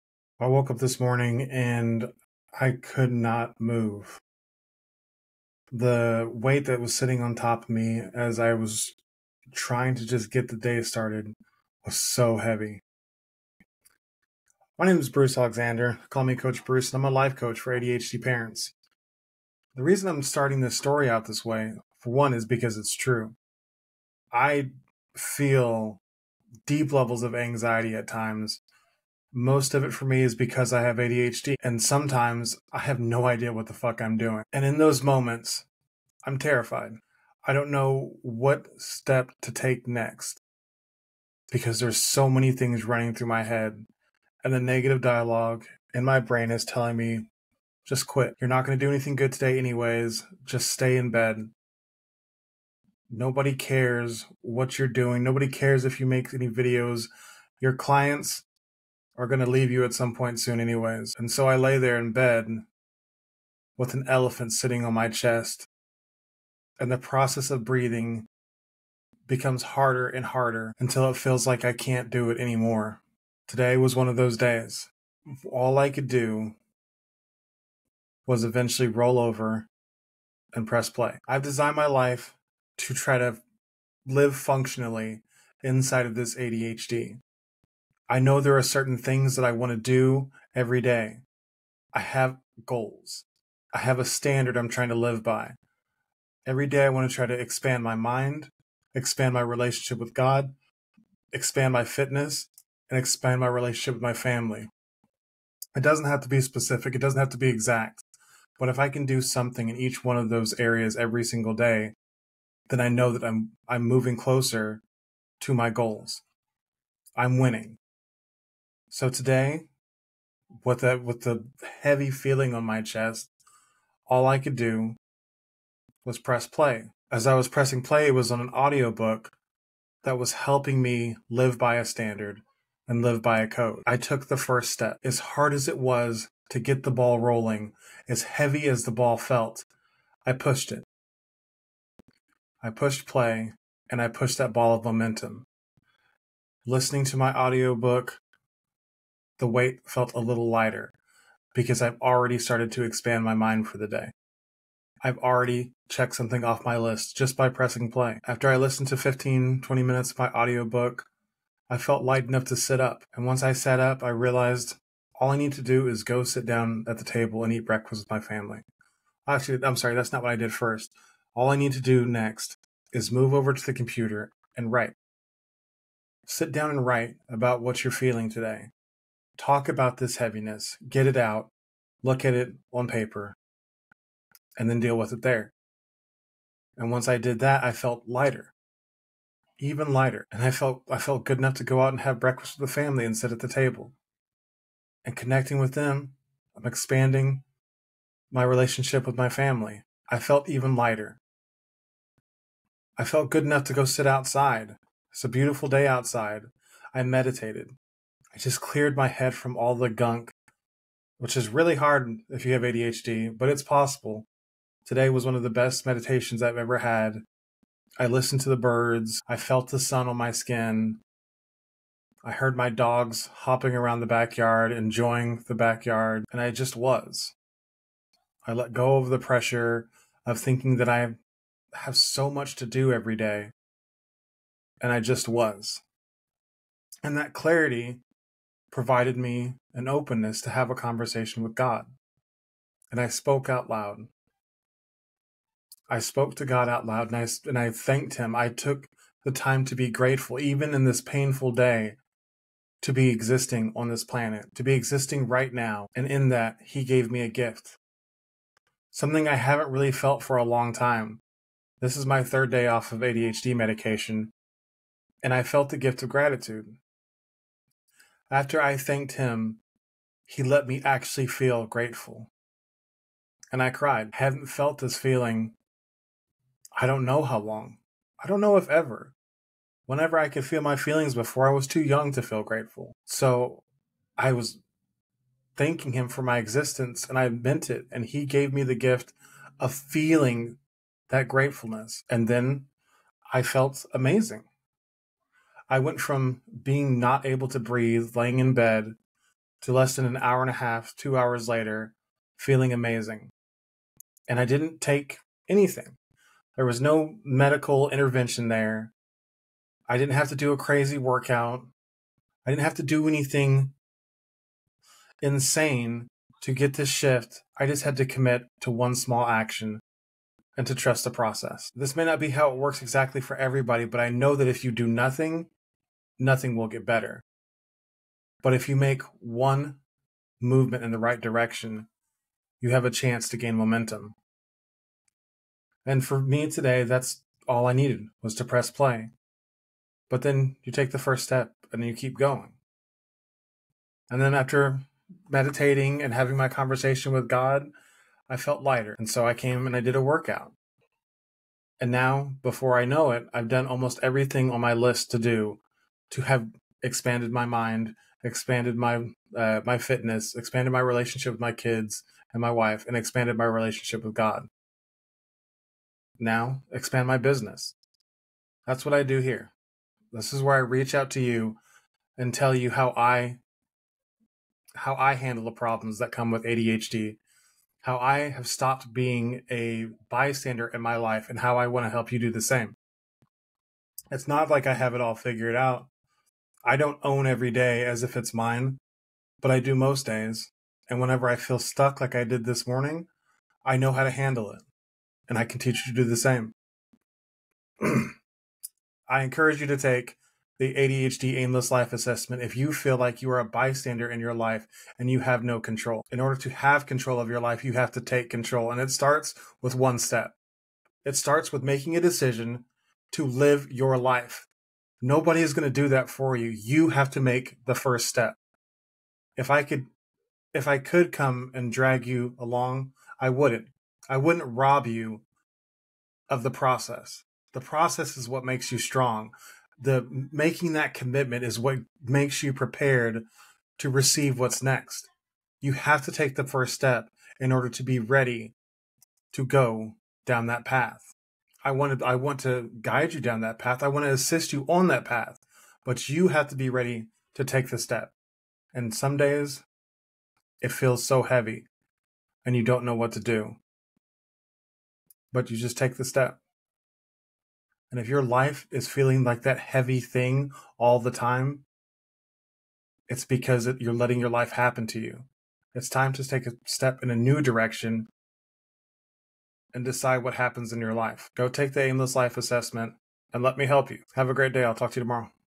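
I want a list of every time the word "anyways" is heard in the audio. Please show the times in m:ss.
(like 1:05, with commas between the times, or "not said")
0:49, 1:00.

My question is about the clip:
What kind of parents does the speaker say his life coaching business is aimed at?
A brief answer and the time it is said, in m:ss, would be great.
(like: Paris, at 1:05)
ADHD parents, at 0:17.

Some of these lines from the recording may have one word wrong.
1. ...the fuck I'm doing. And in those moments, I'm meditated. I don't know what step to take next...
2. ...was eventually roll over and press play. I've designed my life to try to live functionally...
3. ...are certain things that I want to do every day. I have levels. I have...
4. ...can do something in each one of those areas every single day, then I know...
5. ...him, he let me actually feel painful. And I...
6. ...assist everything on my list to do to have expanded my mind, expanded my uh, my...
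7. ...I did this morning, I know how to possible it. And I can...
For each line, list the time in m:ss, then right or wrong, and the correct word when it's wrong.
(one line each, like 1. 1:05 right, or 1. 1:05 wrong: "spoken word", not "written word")
1. 0:33 wrong: "terrified", not "meditated"
2. 1:18 right
3. 1:28 wrong: "goals", not "levels"
4. 1:48 right
5. 4:29 wrong: "grateful", not "painful"
6. 5:53 wrong: "almost", not "assist"
7. 6:32 wrong: "handle", not "possible".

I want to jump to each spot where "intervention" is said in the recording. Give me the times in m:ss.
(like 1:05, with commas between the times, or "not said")
5:07.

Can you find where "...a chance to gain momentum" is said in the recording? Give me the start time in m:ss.
5:32.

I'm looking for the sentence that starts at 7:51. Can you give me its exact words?
Go take the aimless life assessment and let me help you.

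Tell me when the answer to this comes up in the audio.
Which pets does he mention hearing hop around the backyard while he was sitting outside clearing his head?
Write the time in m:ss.
3:42.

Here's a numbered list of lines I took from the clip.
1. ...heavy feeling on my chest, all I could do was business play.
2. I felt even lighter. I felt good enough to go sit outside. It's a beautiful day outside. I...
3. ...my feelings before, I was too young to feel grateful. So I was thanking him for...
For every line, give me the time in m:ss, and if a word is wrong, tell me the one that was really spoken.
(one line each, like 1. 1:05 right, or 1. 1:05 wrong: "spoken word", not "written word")
1. 2:01 wrong: "press", not "business"
2. 3:20 right
3. 4:40 right.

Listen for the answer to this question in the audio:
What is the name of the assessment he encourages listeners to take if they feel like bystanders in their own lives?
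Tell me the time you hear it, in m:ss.
6:40.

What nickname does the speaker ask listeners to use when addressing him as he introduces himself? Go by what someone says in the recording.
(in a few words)
Coach Bruce.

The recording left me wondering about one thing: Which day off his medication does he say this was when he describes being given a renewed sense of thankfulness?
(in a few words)
third day.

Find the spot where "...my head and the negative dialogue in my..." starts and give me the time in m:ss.
0:43.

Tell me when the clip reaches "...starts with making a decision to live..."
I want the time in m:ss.
6:51.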